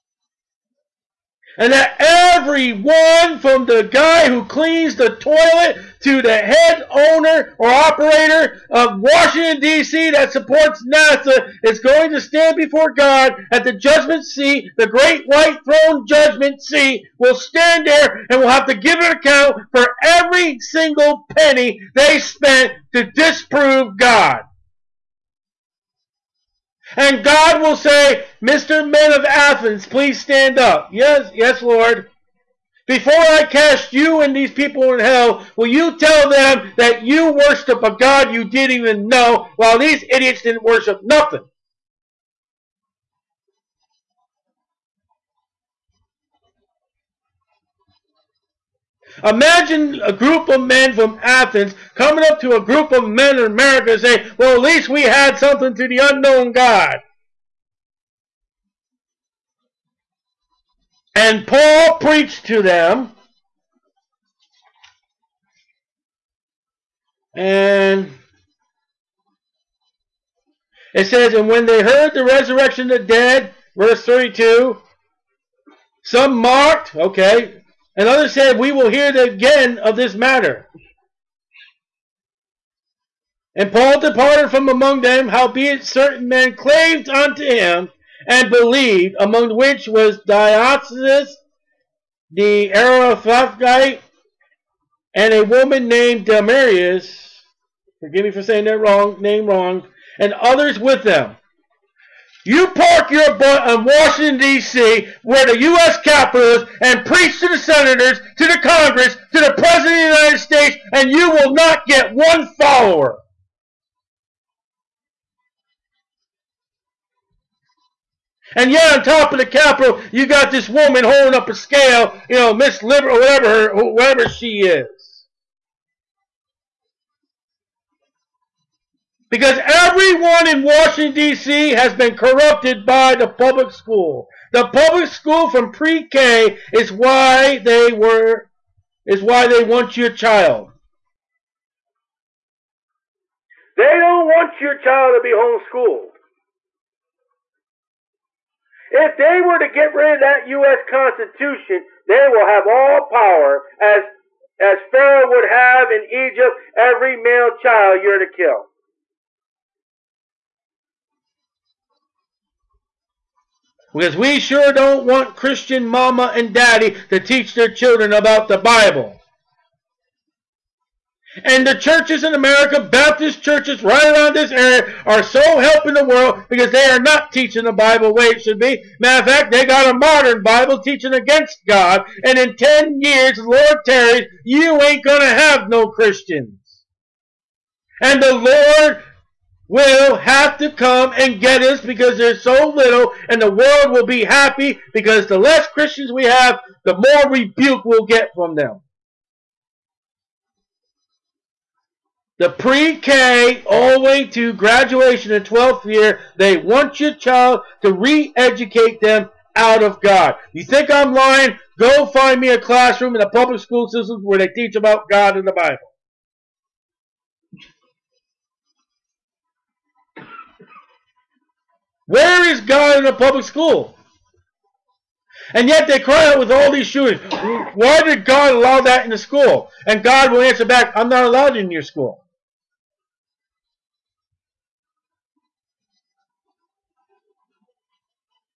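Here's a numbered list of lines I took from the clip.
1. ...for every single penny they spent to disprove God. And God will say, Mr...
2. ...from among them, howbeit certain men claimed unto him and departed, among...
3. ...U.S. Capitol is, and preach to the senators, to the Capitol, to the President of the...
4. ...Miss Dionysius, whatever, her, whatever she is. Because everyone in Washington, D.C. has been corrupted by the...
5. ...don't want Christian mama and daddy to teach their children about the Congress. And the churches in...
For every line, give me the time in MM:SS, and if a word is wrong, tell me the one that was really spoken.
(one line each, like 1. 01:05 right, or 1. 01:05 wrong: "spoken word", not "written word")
1. 00:19 right
2. 01:24 wrong: "believed", not "departed"
3. 01:45 wrong: "Congress", not "Capitol"
4. 02:02 wrong: "Liberal", not "Dionysius"
5. 02:44 wrong: "Bible", not "Congress".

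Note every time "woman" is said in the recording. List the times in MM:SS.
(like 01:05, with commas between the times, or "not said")
01:35, 02:00.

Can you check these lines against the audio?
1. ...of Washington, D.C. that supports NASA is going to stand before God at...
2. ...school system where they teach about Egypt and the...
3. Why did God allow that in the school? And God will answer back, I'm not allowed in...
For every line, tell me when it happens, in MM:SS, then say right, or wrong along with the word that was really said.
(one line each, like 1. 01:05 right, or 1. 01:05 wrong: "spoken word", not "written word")
1. 00:08 right
2. 03:33 wrong: "God", not "Egypt"
3. 03:47 right.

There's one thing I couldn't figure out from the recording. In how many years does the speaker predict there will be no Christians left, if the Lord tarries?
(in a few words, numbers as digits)
10.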